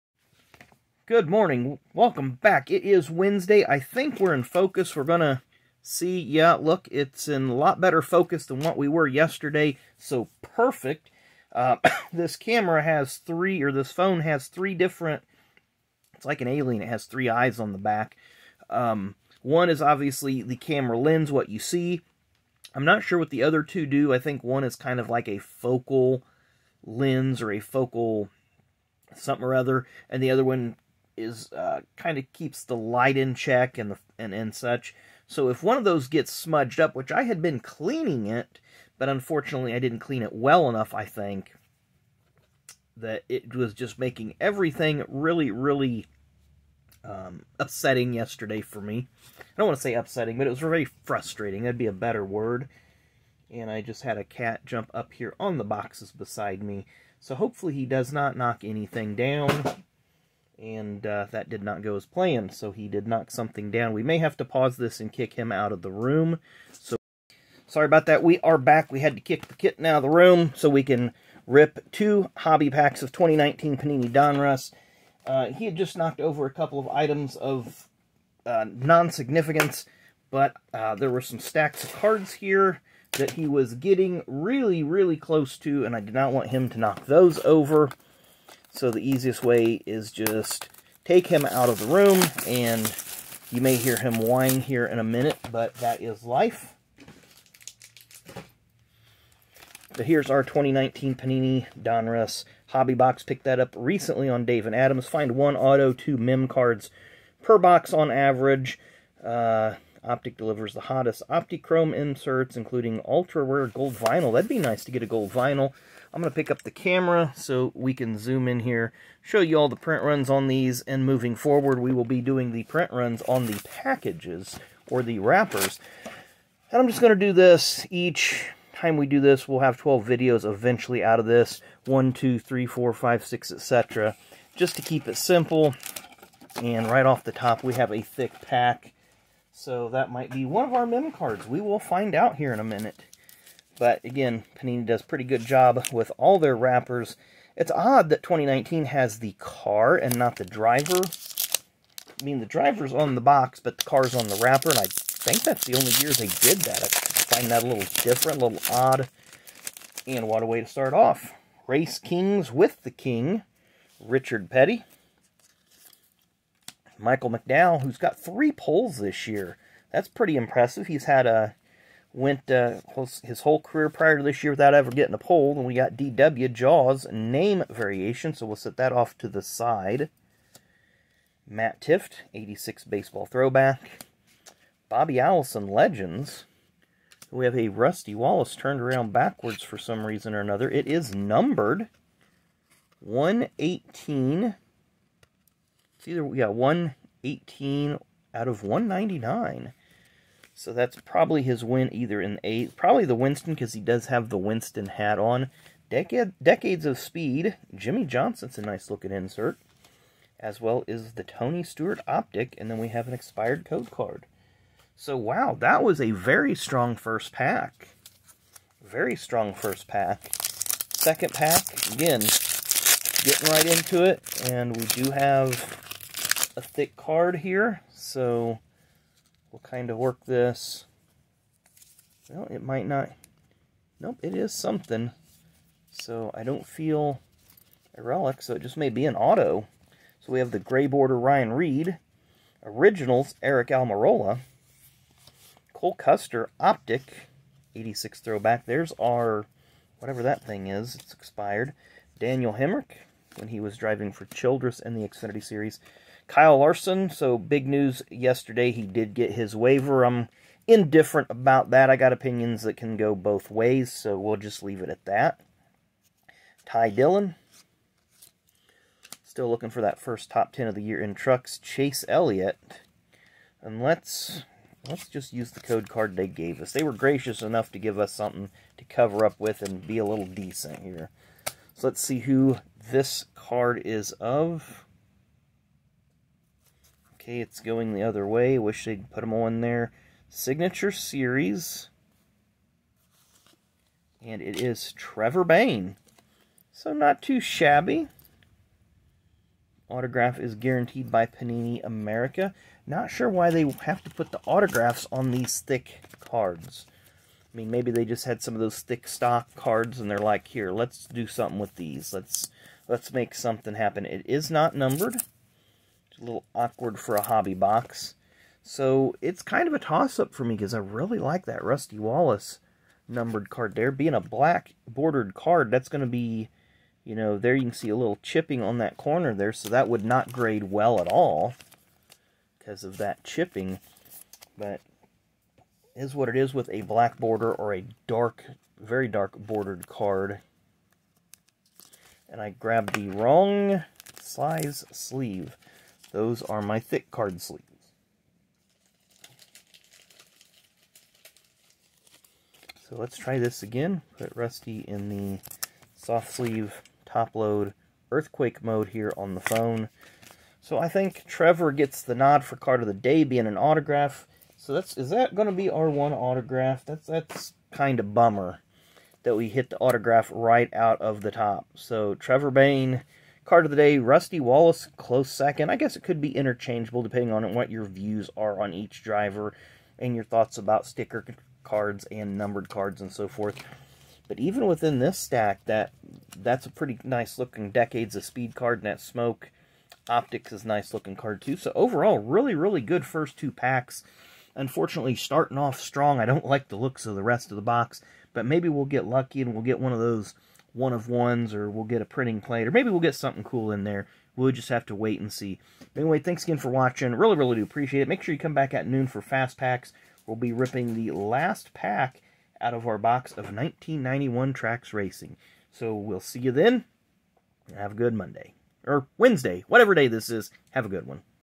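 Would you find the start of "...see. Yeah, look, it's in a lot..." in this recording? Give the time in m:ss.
0:05.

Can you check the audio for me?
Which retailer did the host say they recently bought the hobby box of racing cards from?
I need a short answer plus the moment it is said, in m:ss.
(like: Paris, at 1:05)
Dave and Adam's, at 1:44.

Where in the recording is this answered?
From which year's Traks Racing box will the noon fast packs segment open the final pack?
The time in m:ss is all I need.
6:53.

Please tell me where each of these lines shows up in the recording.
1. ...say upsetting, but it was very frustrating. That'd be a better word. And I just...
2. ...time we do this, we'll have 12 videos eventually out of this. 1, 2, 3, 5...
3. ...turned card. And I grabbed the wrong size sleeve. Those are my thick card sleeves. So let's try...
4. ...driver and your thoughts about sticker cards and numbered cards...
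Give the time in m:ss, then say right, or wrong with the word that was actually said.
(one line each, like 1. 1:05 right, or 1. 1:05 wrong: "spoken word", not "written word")
1. 0:49 right
2. 2:08 wrong: "4", not "5"
3. 5:39 wrong: "bordered", not "turned"
4. 6:19 right.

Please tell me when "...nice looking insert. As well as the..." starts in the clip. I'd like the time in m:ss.
3:28.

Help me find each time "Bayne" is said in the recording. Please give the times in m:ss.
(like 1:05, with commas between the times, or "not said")
4:55, 6:12.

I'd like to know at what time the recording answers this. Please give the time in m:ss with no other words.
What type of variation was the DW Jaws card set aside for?
2:57.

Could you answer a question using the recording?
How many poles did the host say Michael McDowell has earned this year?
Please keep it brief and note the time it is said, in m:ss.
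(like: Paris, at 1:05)
3, at 2:48.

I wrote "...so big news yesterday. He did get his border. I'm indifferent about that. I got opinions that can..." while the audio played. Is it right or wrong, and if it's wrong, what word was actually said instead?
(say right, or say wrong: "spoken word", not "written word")
wrong: "waiver", not "border".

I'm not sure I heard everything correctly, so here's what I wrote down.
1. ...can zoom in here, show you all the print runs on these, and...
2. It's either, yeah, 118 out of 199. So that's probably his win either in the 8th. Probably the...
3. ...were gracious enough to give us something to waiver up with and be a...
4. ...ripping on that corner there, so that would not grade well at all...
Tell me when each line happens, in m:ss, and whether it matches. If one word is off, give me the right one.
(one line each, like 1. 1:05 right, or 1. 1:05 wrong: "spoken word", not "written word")
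1. 1:57 right
2. 3:15 right
3. 4:36 wrong: "cover", not "waiver"
4. 5:28 wrong: "chipping", not "ripping".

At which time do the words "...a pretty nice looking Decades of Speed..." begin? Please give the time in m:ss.
6:26.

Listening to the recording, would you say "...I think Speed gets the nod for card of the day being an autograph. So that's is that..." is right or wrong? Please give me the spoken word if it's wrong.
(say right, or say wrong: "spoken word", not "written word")
wrong: "Trevor", not "Speed".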